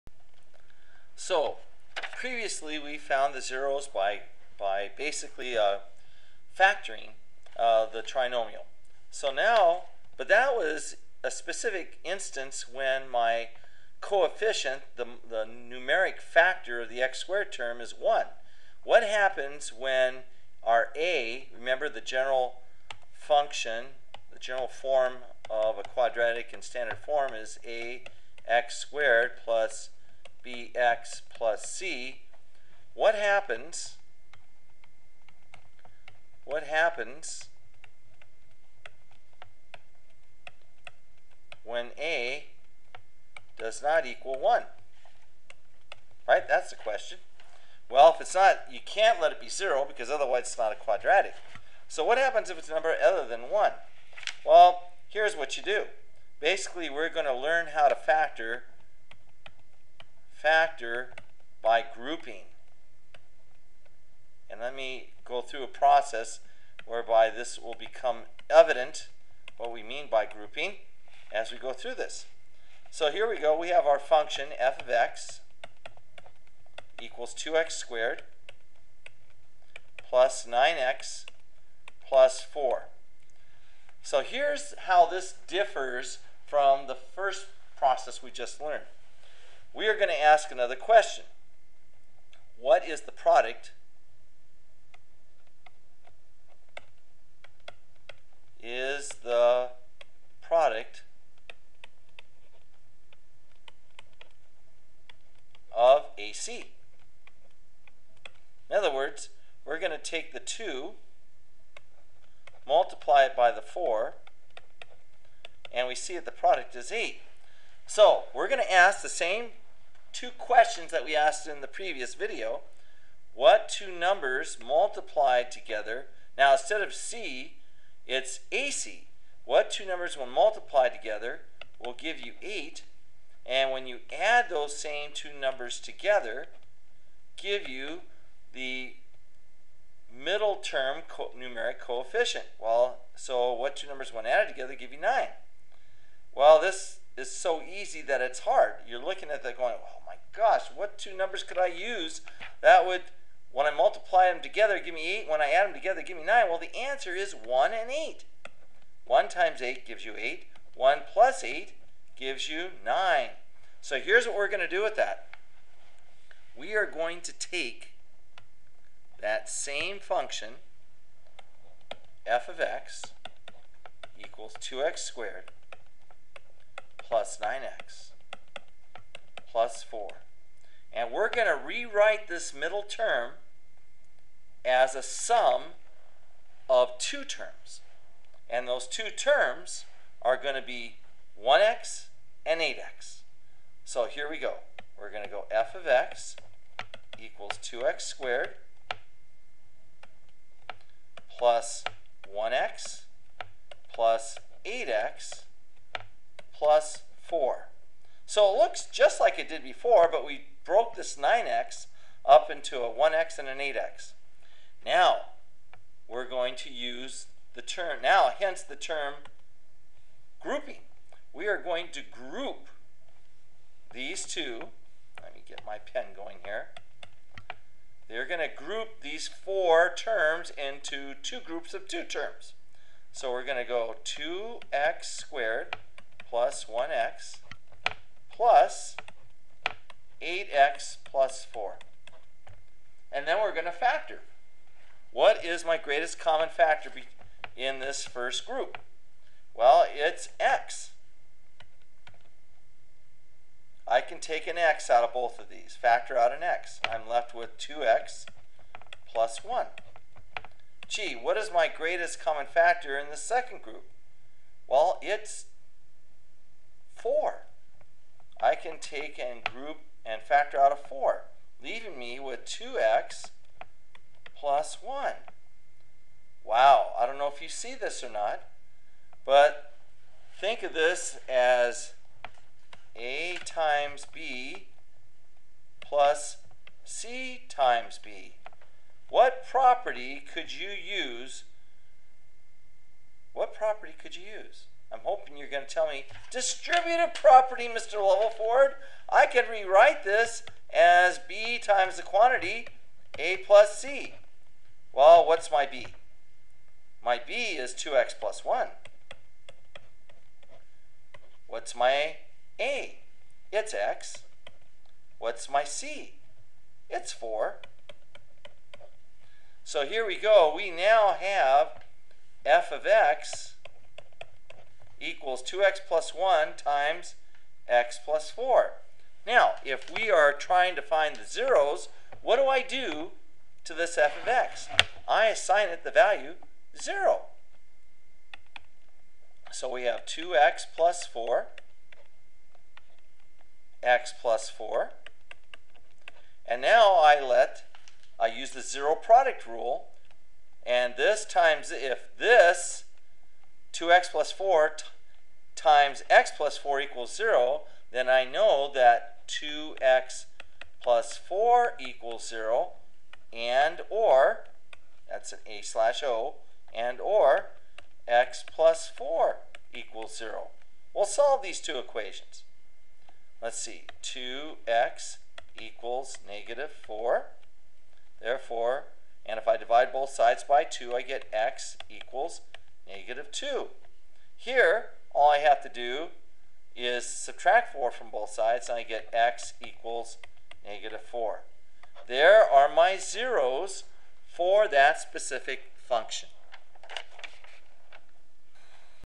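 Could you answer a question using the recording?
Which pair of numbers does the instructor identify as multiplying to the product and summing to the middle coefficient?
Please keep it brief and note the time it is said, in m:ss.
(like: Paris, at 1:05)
1 and 8, at 2:37.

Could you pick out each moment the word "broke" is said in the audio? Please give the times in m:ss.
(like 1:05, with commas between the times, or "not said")
3:30.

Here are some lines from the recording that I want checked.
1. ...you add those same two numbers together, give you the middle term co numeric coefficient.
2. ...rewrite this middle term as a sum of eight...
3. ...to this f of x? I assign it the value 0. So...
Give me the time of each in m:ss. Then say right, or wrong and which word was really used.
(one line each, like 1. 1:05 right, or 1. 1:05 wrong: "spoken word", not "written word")
1. 2:13 right
2. 3:01 wrong: "two", not "eight"
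3. 5:33 right.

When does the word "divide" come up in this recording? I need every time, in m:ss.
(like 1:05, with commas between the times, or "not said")
6:19.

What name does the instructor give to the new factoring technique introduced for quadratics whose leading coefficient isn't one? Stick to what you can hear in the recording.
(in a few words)
factor by grouping.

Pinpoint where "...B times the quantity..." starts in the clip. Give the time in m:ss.
5:01.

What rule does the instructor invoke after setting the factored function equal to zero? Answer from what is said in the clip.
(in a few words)
zero product rule.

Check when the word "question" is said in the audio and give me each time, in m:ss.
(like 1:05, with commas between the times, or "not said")
0:46, 1:30, 2:00.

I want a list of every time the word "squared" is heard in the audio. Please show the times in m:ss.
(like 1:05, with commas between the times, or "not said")
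0:17, 0:28, 1:17, 2:54, 3:18, 3:55.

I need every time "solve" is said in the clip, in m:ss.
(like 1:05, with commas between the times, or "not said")
6:11.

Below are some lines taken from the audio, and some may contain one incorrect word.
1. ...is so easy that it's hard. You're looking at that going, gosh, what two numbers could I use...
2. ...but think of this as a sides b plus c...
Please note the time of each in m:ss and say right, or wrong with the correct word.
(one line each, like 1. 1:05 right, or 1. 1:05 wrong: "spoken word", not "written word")
1. 2:27 right
2. 4:39 wrong: "times", not "sides".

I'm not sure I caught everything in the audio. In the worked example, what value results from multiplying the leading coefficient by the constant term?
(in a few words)
8.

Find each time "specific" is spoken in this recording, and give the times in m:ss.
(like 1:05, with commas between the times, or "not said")
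0:11, 6:34.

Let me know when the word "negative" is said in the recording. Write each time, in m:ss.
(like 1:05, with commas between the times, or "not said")
6:16, 6:22, 6:30.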